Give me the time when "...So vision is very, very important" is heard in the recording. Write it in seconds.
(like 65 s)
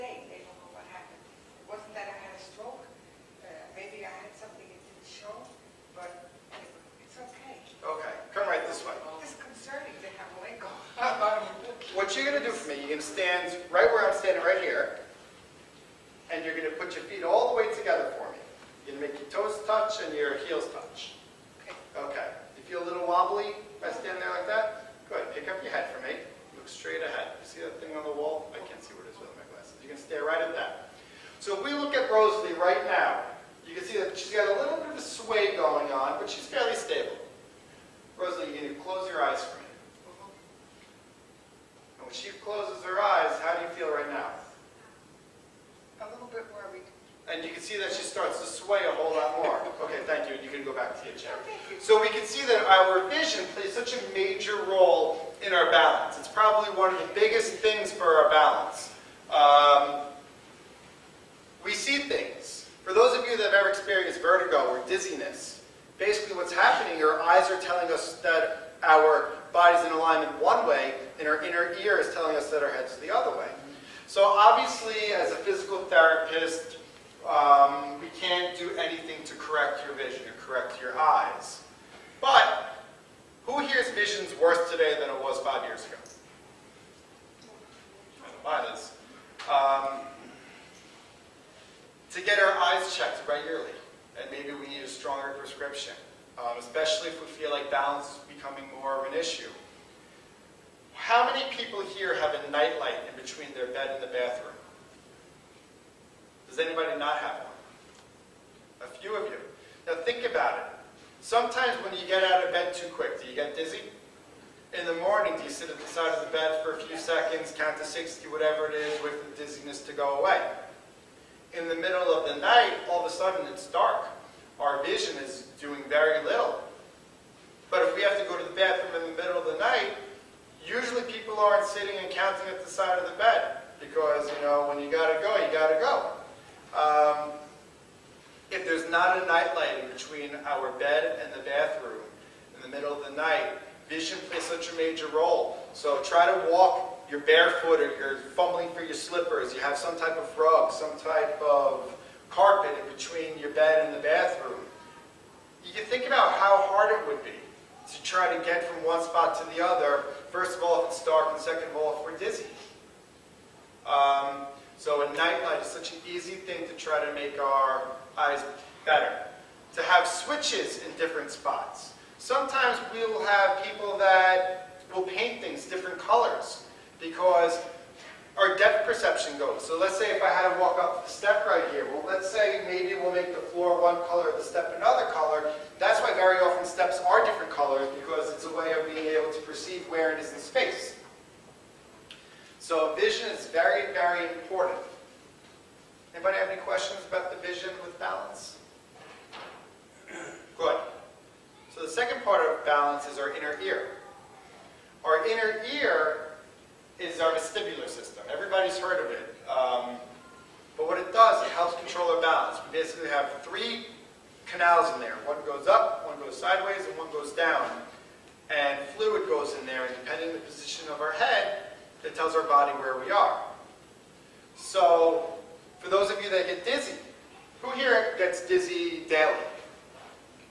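192 s.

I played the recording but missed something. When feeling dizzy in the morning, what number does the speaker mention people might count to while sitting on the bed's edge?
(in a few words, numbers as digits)
60.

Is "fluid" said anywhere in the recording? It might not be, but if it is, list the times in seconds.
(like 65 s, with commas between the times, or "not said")
218 s.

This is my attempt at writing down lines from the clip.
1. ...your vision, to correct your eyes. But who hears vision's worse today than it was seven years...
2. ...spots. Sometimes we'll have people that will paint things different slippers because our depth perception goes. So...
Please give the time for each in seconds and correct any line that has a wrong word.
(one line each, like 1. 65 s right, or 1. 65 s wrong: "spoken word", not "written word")
1. 79 s wrong: "five", not "seven"
2. 171 s wrong: "colors", not "slippers".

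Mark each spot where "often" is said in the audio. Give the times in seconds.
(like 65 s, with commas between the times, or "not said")
186 s.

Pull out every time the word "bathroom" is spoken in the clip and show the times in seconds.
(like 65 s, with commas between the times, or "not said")
104 s, 128 s, 141 s, 153 s.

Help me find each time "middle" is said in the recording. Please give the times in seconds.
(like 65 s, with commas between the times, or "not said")
121 s, 129 s, 142 s.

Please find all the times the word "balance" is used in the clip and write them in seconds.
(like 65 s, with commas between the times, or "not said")
97 s, 197 s, 202 s, 212 s.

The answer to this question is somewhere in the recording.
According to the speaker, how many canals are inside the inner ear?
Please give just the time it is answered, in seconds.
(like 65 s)
213 s.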